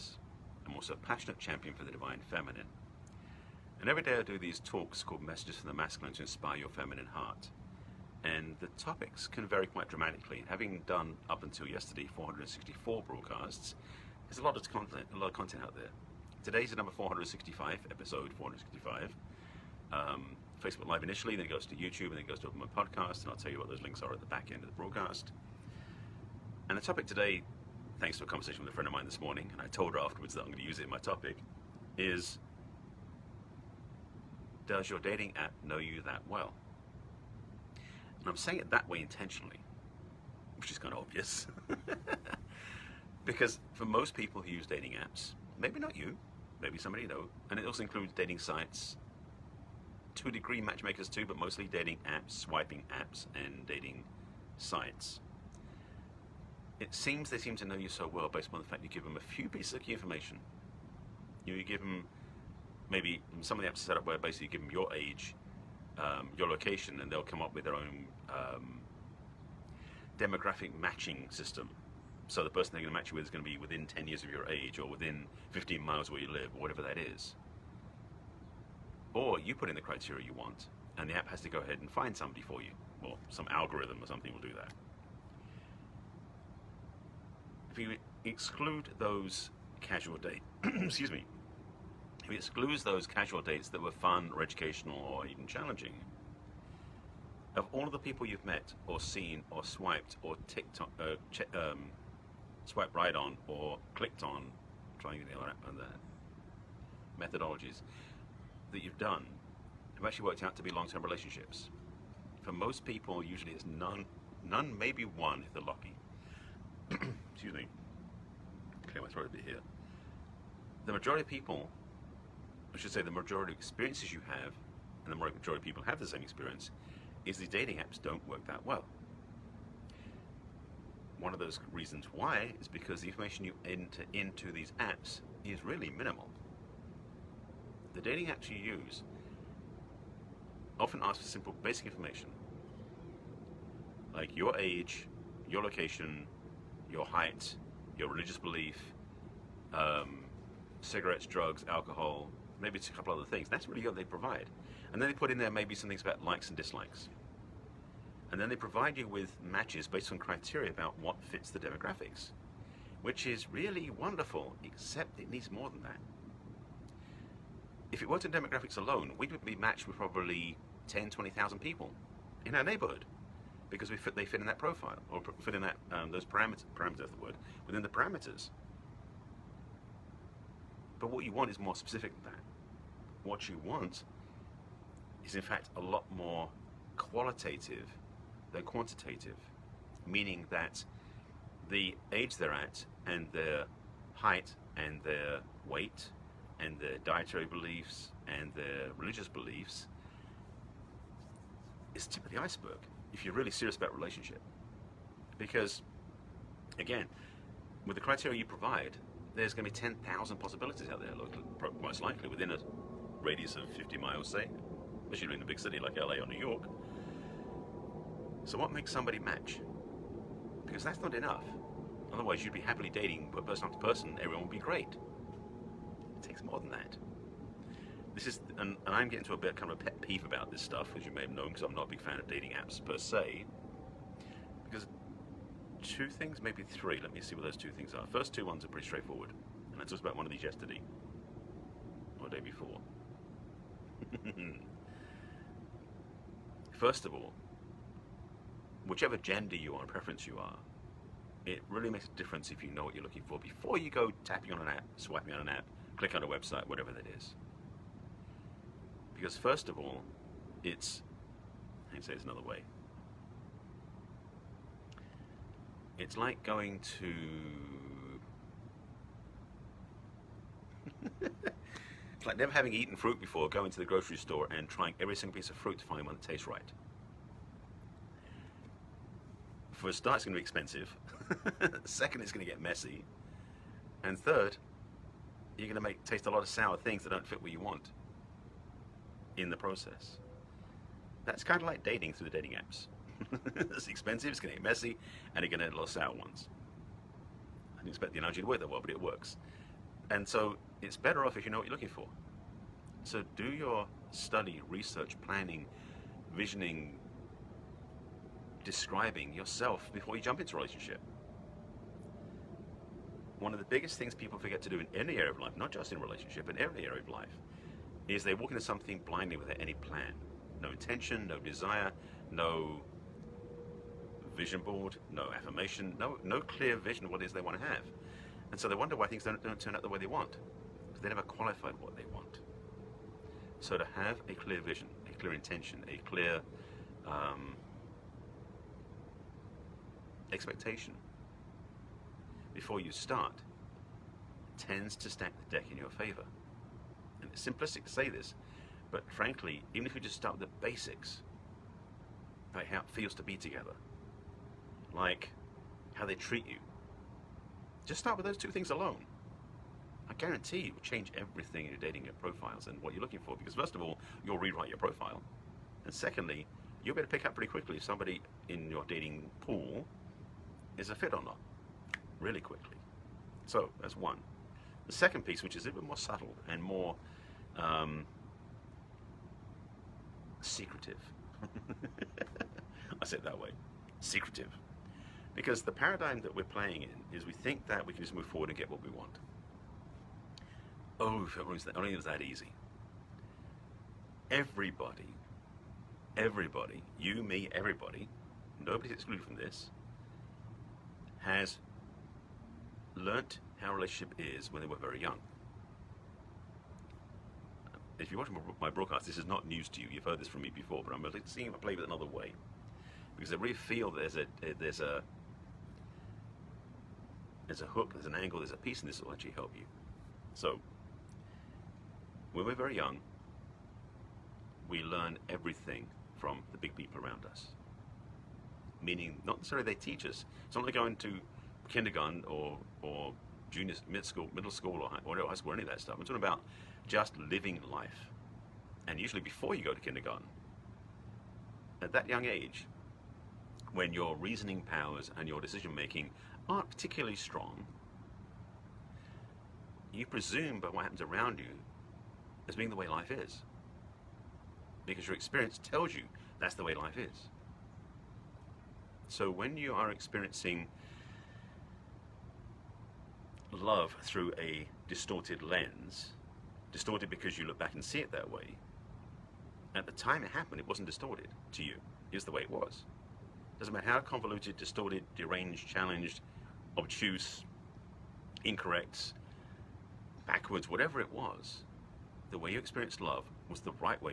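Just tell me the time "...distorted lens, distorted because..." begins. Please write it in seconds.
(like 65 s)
464 s.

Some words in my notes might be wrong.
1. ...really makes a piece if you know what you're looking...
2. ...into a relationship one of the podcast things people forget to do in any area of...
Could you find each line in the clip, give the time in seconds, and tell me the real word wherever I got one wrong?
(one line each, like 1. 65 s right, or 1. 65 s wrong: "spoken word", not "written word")
1. 251 s wrong: "difference", not "piece"
2. 310 s wrong: "biggest", not "podcast".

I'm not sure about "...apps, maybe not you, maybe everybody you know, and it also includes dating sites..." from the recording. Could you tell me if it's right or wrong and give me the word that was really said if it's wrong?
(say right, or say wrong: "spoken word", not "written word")
wrong: "somebody", not "everybody".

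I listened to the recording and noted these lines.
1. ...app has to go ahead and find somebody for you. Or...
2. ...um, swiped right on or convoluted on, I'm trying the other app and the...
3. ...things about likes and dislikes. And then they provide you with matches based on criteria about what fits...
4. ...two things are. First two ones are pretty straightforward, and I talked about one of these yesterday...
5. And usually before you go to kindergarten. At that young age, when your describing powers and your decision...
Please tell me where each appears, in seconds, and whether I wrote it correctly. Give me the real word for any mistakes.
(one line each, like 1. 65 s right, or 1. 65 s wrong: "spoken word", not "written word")
1. 81 s right
2. 101 s wrong: "clicked", not "convoluted"
3. 155 s right
4. 237 s right
5. 438 s wrong: "reasoning", not "describing".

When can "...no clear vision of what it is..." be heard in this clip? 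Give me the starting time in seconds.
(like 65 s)
326 s.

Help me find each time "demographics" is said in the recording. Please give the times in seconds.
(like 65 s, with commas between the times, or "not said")
70 s, 161 s, 168 s.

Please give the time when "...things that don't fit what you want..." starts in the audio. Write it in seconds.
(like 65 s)
286 s.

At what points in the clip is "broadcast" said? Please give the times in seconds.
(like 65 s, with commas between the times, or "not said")
13 s, 24 s, 408 s.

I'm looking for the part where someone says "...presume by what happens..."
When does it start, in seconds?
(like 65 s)
450 s.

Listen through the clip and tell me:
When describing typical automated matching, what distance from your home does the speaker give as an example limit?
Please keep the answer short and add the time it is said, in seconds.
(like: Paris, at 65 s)
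15 miles, at 75 s.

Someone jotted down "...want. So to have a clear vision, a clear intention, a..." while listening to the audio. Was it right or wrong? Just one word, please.
right.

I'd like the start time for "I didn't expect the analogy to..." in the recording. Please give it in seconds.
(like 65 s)
297 s.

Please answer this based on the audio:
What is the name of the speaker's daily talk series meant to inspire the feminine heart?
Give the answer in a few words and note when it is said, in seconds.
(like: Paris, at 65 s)
Messages from the Masculine, at 5 s.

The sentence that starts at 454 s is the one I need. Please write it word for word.
Because your experience tells you that's the way life is.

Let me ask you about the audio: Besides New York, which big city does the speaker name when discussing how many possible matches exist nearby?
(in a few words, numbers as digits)
LA.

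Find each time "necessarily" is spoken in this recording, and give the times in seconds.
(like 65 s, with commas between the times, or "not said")
429 s.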